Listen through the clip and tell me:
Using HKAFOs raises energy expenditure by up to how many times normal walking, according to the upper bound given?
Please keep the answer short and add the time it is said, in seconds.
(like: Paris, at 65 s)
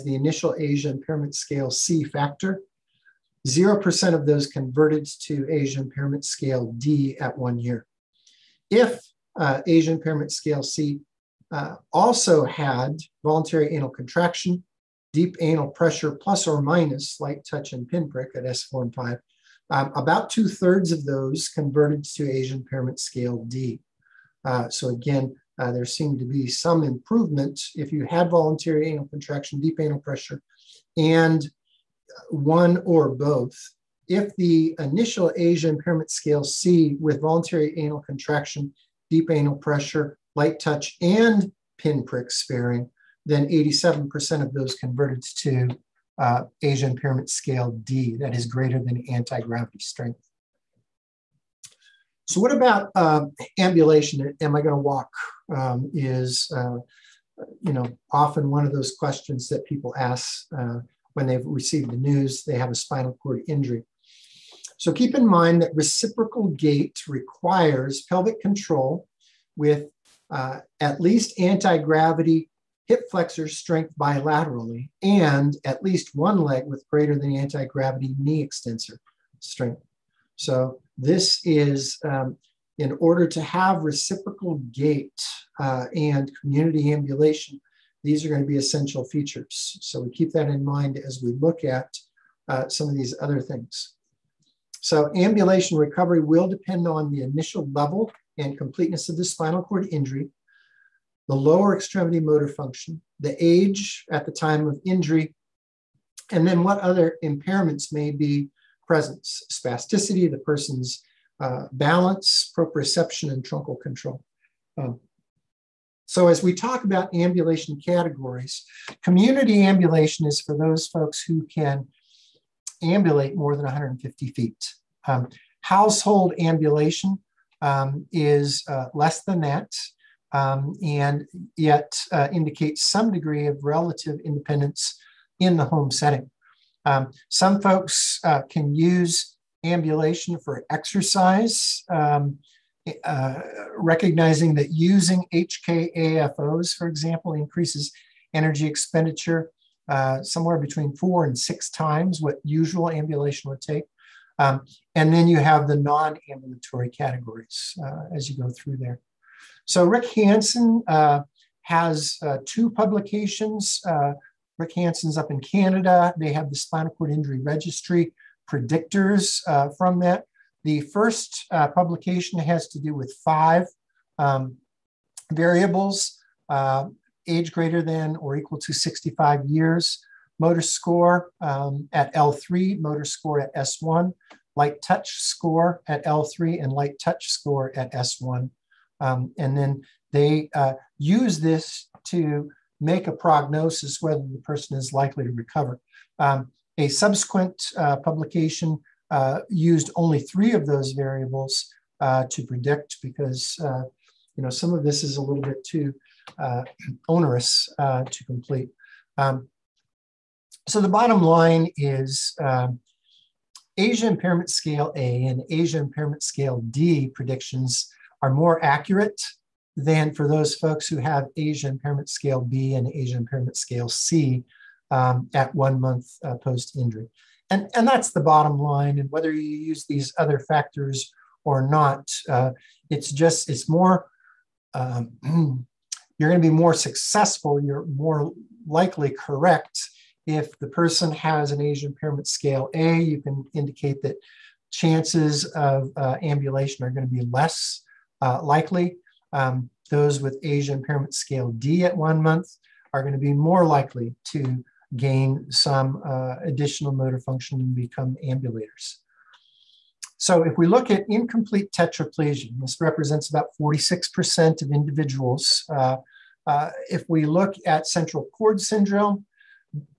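6, at 151 s.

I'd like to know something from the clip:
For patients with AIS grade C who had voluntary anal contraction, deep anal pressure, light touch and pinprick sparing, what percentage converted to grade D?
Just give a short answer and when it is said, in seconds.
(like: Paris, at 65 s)
87%, at 43 s.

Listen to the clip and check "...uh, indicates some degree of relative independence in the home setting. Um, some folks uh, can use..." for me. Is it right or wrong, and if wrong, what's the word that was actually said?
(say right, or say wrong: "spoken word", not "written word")
right.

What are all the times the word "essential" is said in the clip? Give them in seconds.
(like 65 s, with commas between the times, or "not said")
88 s.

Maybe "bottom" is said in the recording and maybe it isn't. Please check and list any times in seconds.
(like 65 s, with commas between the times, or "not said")
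210 s, 228 s.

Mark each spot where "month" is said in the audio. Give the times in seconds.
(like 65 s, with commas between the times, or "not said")
225 s, 252 s.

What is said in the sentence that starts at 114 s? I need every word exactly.
Um, so, as we talk about ambulation categories, community ambulation is for those folks who can ambulate more than 150 feet.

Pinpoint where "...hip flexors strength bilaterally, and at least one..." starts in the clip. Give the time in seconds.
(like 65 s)
72 s.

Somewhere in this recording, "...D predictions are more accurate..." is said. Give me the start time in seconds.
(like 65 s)
216 s.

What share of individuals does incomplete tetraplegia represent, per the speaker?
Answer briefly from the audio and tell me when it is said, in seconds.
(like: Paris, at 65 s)
46%, at 263 s.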